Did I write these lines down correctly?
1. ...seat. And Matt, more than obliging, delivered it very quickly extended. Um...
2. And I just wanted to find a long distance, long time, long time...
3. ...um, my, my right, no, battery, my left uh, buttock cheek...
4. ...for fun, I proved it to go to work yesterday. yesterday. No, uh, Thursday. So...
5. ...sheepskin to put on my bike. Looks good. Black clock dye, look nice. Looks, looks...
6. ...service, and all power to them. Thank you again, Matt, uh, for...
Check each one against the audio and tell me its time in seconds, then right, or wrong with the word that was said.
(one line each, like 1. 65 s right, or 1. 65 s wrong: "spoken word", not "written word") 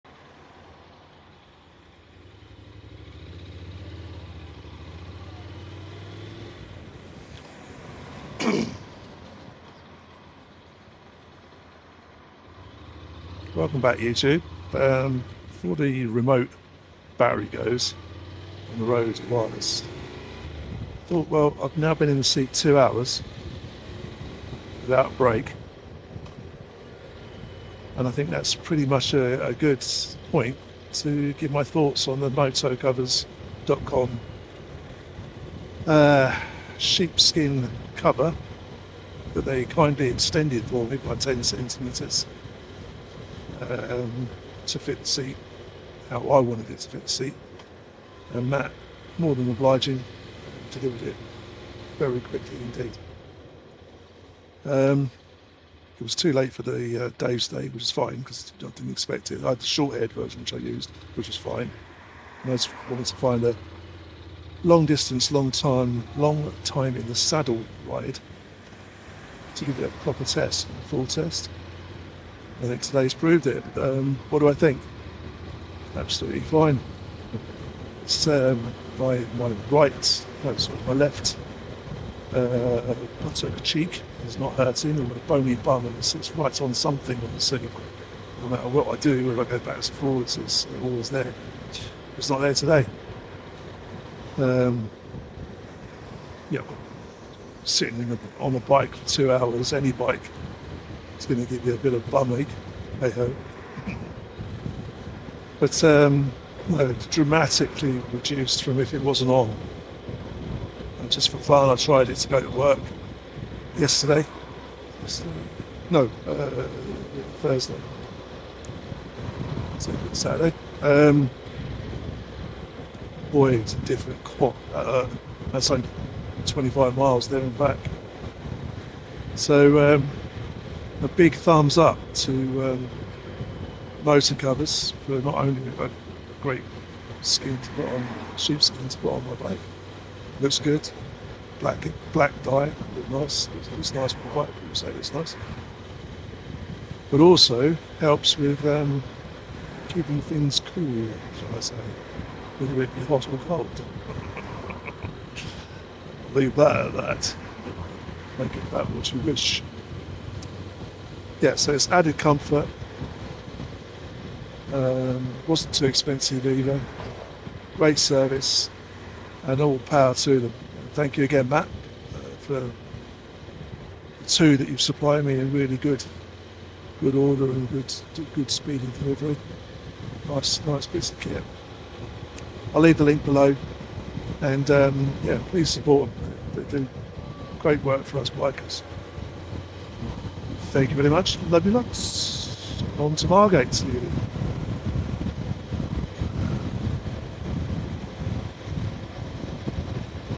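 1. 47 s wrong: "indeed", not "extended"
2. 62 s right
3. 78 s wrong: "sorry", not "battery"
4. 111 s wrong: "tried", not "proved"
5. 138 s wrong: "black", not "clock"
6. 167 s right.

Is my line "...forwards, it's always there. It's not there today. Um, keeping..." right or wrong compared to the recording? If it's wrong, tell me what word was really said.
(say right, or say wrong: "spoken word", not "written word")
wrong: "sitting", not "keeping".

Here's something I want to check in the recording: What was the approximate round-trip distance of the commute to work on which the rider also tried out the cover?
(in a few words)
25 miles.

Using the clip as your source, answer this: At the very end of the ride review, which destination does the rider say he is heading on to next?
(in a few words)
Margate.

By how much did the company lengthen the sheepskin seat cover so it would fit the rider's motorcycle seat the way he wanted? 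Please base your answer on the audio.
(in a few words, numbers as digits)
10 centimetres.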